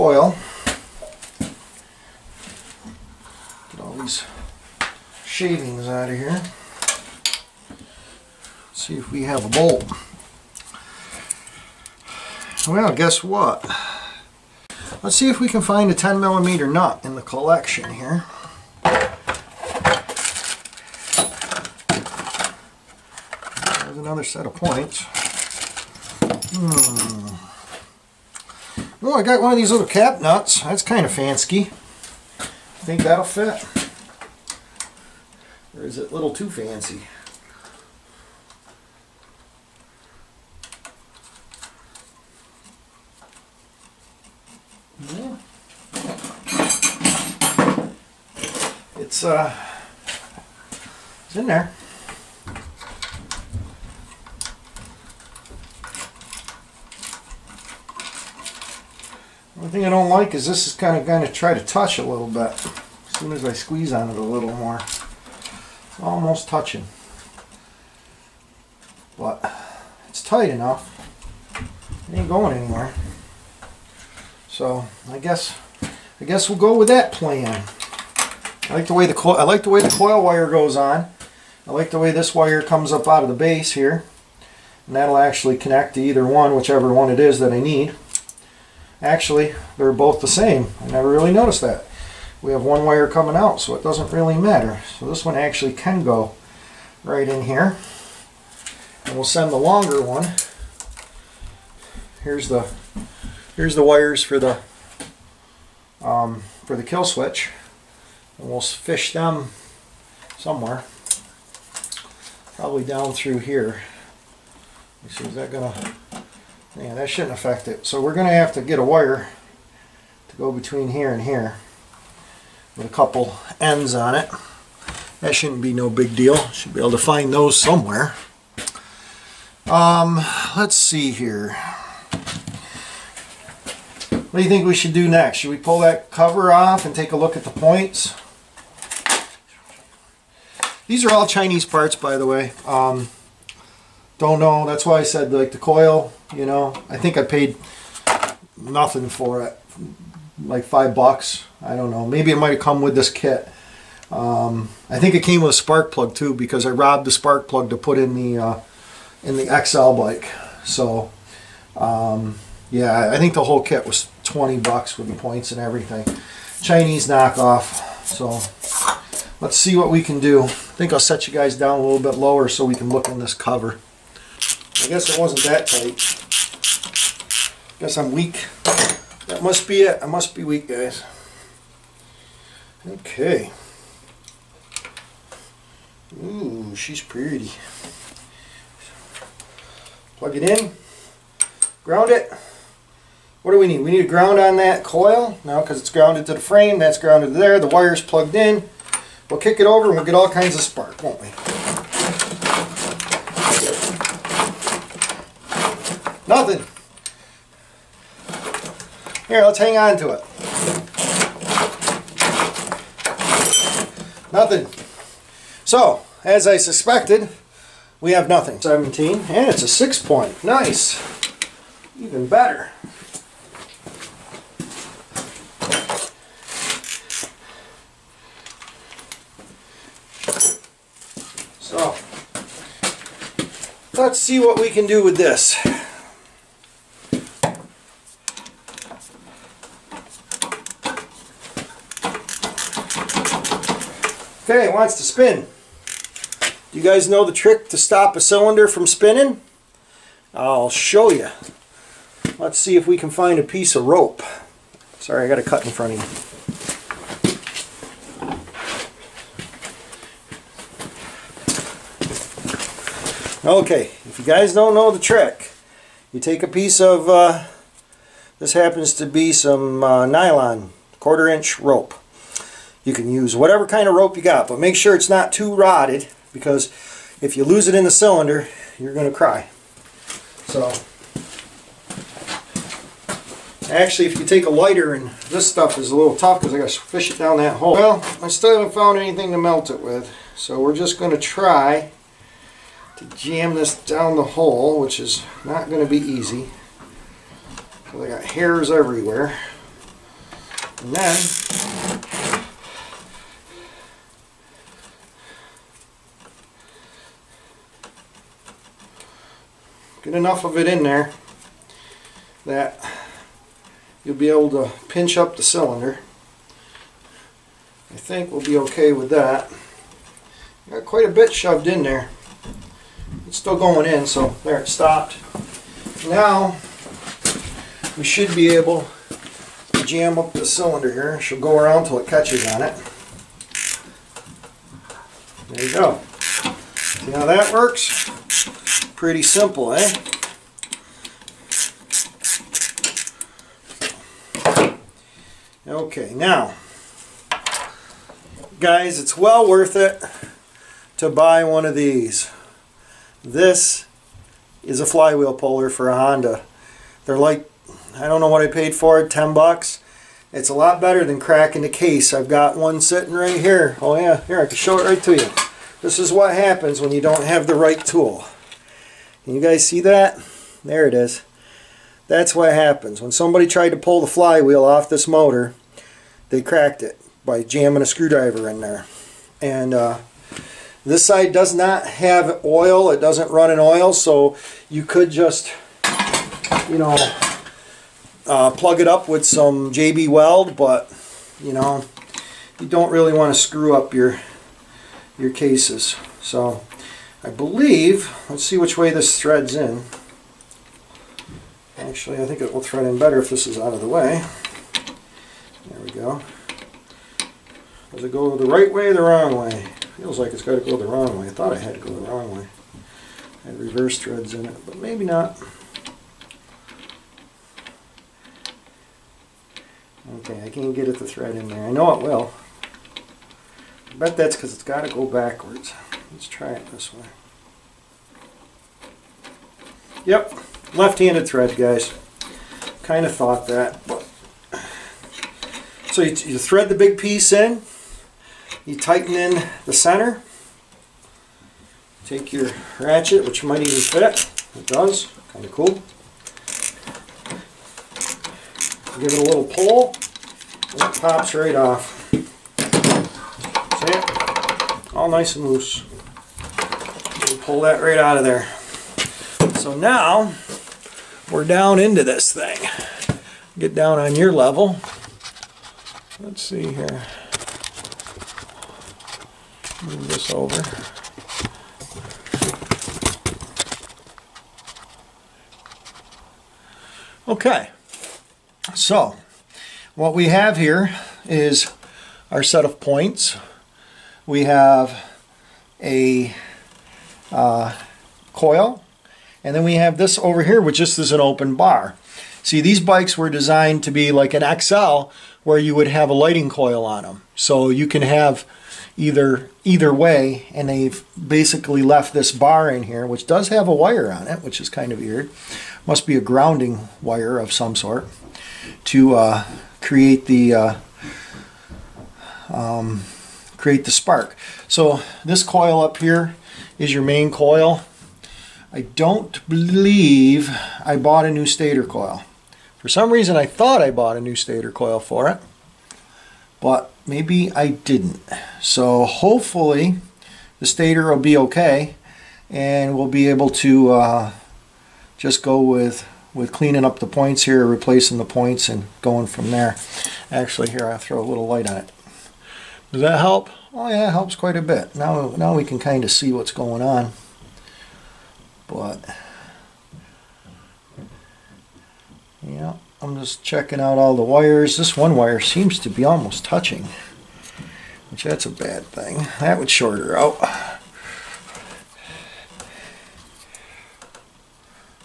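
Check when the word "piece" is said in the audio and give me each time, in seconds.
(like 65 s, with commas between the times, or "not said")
253 s, 266 s, 436 s.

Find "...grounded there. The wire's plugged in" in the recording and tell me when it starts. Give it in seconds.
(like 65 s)
196 s.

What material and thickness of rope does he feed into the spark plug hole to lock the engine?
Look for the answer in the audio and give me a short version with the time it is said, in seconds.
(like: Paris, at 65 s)
nylon, quarter inch, at 270 s.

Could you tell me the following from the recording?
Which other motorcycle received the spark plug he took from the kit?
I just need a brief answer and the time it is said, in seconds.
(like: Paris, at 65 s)
XL bike, at 159 s.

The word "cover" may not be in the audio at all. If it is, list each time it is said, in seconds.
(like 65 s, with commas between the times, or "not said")
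136 s, 173 s.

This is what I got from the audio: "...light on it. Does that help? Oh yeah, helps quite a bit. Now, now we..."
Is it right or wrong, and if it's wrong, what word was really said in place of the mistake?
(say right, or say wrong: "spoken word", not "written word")
right.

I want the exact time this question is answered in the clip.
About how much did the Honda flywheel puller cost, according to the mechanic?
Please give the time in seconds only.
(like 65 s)
359 s.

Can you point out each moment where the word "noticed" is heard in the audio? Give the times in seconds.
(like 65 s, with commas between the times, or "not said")
91 s.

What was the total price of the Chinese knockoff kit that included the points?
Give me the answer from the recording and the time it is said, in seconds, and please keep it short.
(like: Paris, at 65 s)
20 bucks, at 164 s.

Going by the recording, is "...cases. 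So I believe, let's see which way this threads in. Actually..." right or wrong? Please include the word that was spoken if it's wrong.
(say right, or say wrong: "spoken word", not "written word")
right.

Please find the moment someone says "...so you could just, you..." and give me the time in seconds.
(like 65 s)
383 s.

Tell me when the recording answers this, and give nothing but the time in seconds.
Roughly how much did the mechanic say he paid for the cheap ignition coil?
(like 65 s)
150 s.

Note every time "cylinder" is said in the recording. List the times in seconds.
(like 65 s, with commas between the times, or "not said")
248 s, 277 s, 315 s, 330 s.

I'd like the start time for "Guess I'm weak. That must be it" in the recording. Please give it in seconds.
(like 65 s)
177 s.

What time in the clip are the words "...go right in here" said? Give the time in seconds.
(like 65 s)
96 s.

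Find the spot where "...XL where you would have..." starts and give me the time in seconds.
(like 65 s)
494 s.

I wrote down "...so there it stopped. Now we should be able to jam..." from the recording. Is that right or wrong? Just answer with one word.
right.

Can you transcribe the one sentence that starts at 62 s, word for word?
As soon as I squeeze on it a little more, it's almost touching.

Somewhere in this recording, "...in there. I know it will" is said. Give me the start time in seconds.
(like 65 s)
421 s.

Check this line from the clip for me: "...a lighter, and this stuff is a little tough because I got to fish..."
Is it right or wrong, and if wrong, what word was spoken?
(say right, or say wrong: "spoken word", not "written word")
right.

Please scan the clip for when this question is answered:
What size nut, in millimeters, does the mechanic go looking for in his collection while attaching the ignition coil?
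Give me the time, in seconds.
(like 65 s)
15 s.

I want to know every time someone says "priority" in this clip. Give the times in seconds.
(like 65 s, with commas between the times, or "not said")
not said.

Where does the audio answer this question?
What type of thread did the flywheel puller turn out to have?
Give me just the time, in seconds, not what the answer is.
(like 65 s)
430 s.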